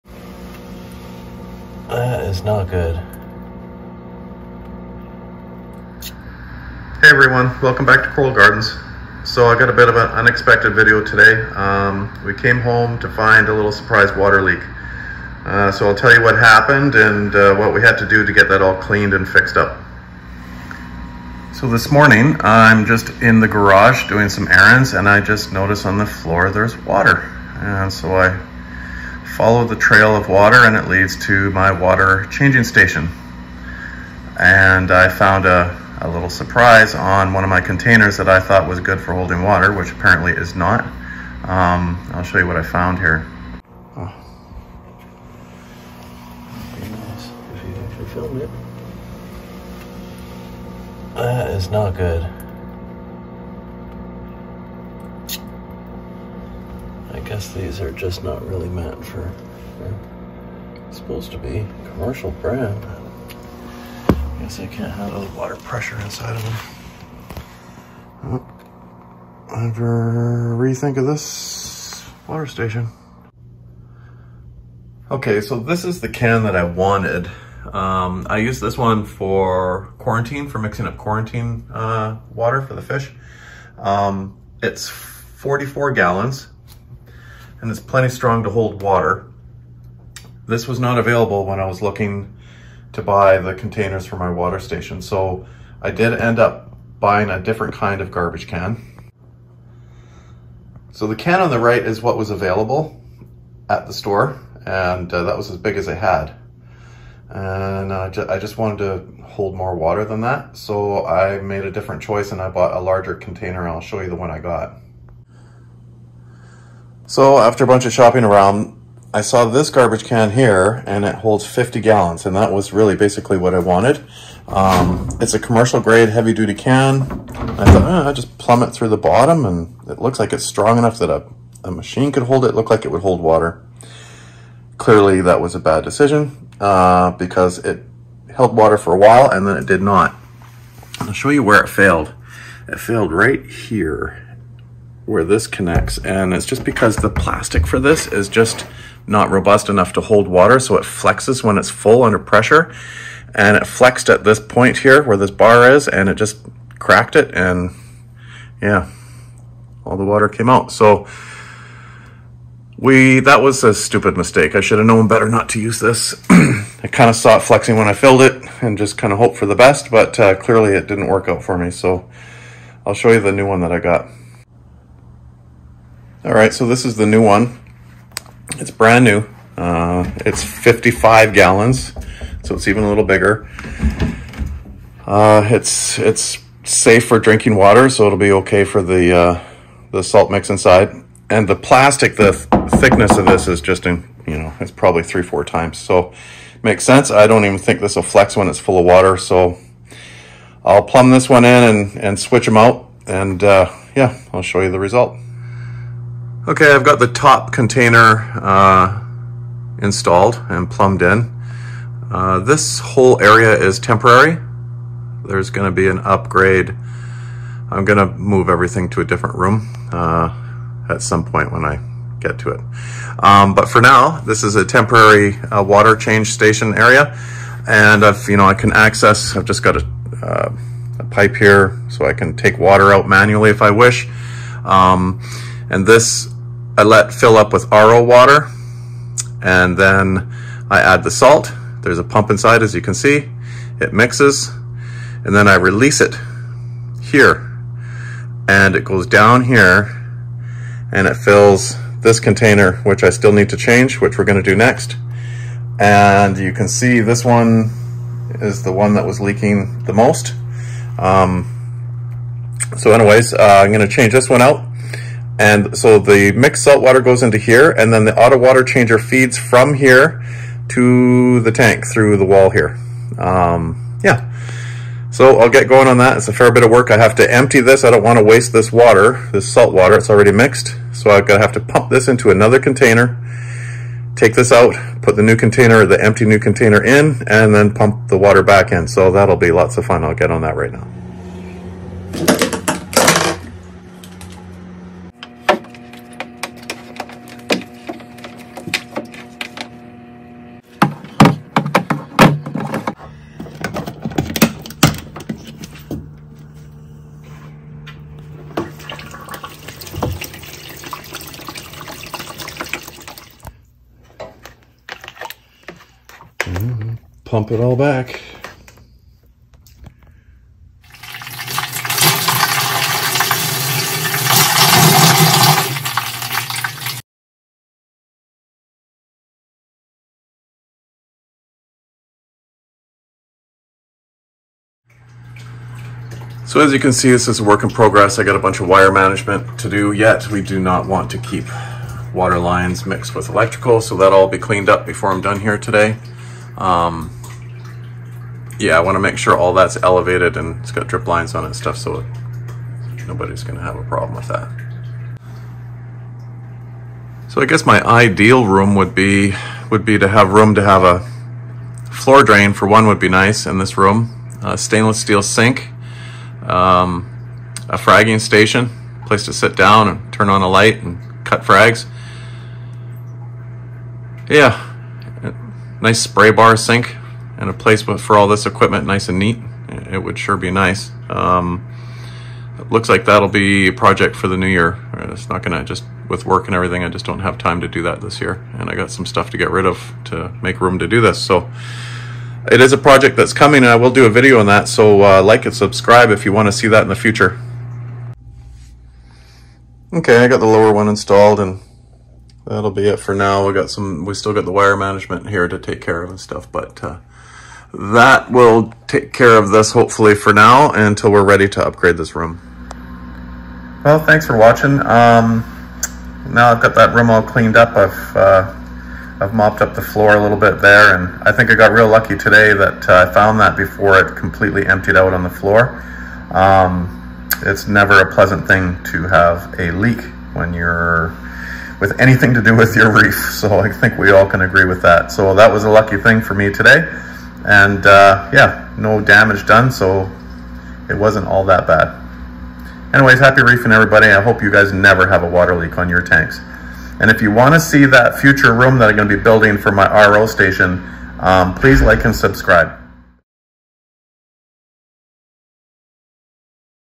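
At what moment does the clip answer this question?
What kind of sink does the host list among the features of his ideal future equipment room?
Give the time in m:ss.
6:04.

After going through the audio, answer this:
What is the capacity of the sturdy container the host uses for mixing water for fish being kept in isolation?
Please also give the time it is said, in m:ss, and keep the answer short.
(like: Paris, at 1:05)
44 gallons, at 1:24.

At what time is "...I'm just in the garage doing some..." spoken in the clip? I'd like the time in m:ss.
0:22.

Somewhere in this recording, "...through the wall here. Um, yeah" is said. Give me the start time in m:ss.
4:31.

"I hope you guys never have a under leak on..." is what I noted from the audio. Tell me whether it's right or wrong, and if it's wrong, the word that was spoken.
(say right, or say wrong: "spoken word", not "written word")
wrong: "water", not "under".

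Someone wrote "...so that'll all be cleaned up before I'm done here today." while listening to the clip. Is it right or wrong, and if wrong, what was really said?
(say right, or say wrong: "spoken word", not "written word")
right.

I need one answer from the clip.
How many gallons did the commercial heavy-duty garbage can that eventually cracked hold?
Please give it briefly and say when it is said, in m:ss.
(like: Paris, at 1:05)
50 gallons, at 2:01.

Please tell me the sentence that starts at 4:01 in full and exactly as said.
There's a pump inside as you can see.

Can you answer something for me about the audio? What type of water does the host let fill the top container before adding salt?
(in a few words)
RO water.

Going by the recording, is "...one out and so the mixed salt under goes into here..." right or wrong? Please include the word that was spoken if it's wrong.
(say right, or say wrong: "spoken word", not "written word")
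wrong: "water", not "under".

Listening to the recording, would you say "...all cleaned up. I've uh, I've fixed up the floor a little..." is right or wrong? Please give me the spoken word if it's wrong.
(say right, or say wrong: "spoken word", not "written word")
wrong: "mopped", not "fixed".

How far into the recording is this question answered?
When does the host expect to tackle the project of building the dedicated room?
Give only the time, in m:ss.
6:24.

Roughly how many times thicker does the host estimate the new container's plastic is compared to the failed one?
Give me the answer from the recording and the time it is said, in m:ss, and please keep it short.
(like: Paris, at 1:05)
3 or 4 times, at 3:15.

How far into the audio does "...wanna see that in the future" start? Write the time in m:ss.
6:36.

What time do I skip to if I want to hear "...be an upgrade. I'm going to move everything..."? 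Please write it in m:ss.
3:35.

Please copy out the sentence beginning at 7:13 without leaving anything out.
So I think we all can agree with that.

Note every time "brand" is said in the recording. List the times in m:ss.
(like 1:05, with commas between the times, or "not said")
1:02, 2:58.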